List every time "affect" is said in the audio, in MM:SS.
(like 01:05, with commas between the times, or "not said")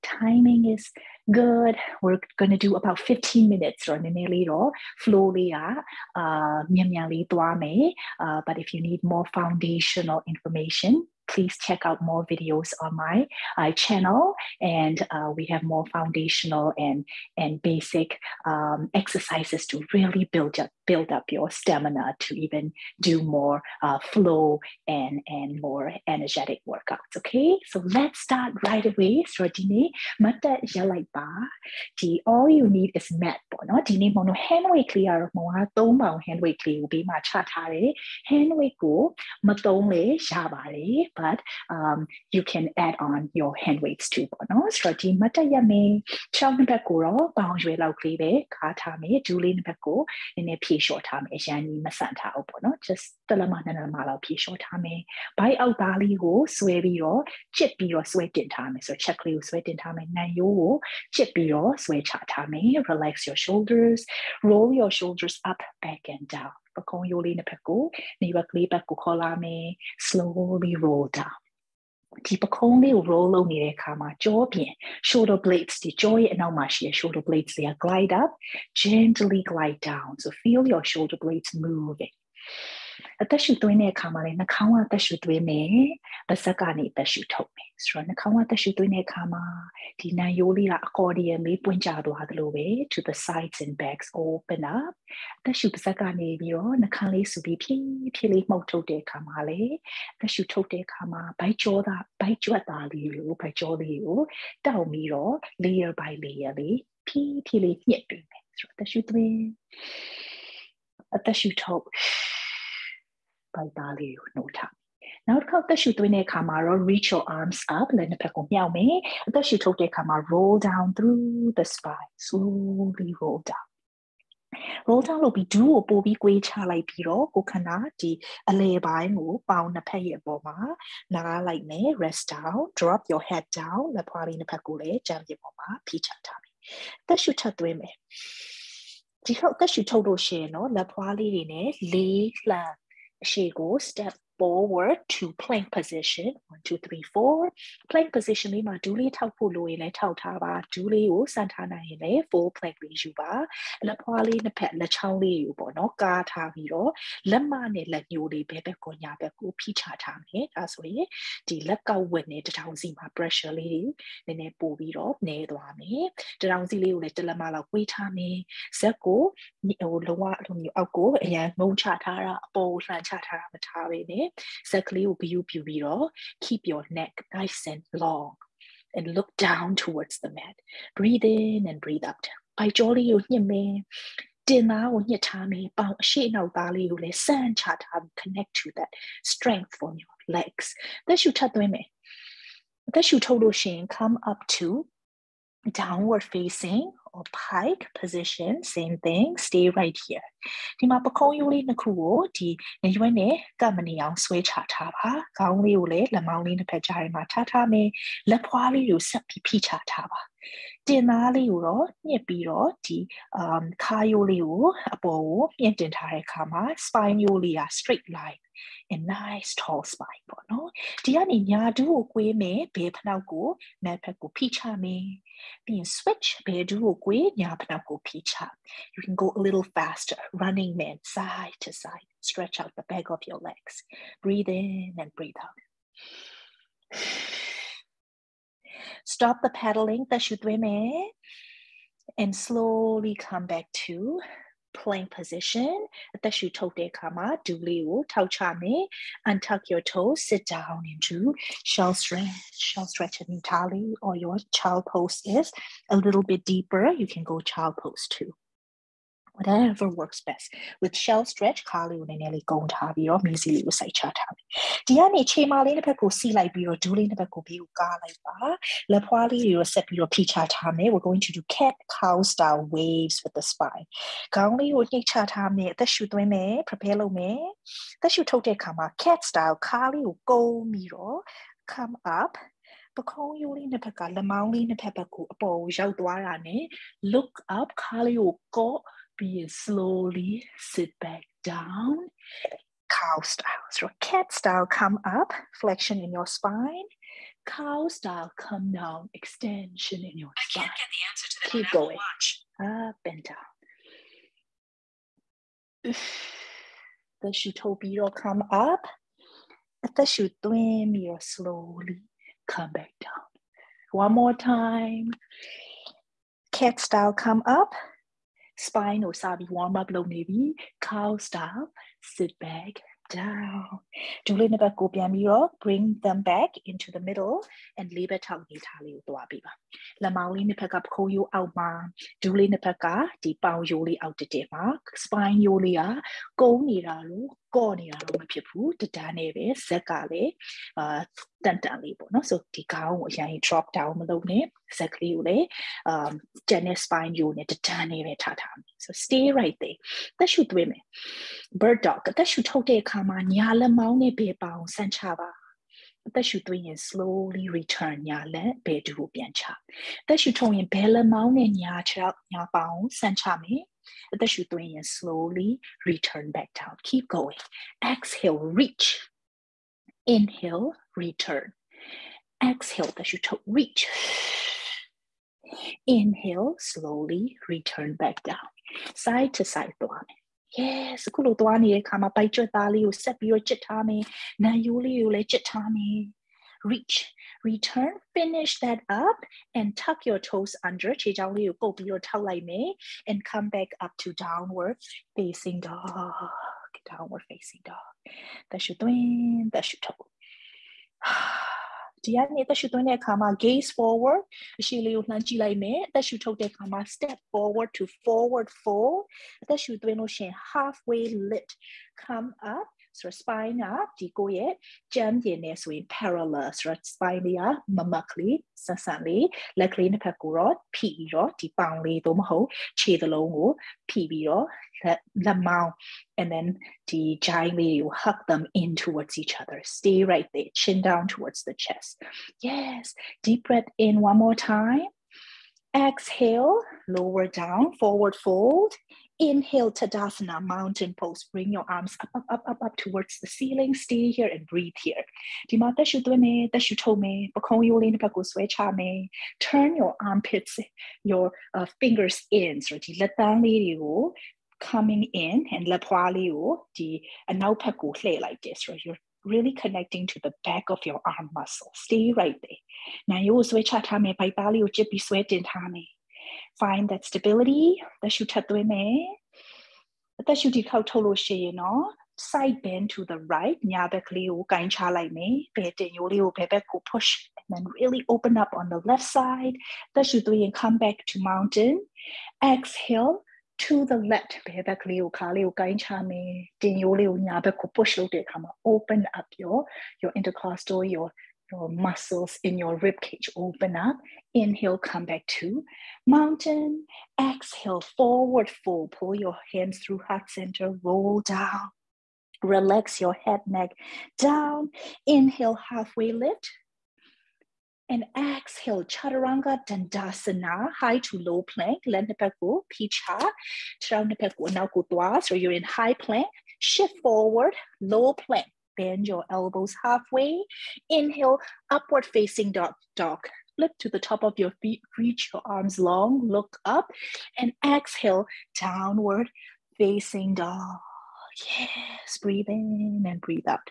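not said.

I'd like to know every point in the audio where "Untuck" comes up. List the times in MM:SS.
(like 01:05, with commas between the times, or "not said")
04:09.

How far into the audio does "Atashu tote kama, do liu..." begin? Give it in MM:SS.
04:06.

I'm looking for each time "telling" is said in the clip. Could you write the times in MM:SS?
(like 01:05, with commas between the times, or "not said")
not said.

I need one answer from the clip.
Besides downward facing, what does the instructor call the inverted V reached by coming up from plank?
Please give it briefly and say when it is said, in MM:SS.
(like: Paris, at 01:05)
pike position, at 03:17.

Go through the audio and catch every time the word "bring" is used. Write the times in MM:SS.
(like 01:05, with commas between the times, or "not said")
05:25, 07:21.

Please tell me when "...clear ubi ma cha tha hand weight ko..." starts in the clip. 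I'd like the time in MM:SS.
00:36.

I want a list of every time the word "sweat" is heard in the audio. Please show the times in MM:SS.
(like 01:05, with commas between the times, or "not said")
07:45.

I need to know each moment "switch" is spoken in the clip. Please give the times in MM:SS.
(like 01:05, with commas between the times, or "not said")
03:45, 07:43.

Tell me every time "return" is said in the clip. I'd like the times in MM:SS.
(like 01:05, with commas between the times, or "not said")
05:57, 06:05, 06:10, 06:17, 06:27.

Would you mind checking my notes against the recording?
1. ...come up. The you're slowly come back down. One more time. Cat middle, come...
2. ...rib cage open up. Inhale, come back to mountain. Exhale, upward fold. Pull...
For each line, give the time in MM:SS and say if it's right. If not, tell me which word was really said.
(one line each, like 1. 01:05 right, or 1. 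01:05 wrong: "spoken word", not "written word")
1. 05:08 wrong: "style", not "middle"
2. 08:12 wrong: "forward", not "upward".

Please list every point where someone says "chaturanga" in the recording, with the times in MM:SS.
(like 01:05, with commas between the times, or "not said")
08:28, 08:33.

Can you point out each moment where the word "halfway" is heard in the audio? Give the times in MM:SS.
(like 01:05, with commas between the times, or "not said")
06:50, 08:25, 08:39.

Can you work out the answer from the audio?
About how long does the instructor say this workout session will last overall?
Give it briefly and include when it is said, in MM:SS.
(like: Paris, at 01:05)
15 minutes, at 00:02.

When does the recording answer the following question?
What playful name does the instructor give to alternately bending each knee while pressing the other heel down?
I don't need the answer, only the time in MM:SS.
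03:50.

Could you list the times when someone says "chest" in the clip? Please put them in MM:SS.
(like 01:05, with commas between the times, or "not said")
07:11.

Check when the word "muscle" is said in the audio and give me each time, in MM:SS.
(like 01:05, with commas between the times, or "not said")
07:41, 08:11.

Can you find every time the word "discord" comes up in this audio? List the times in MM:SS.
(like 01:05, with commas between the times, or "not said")
not said.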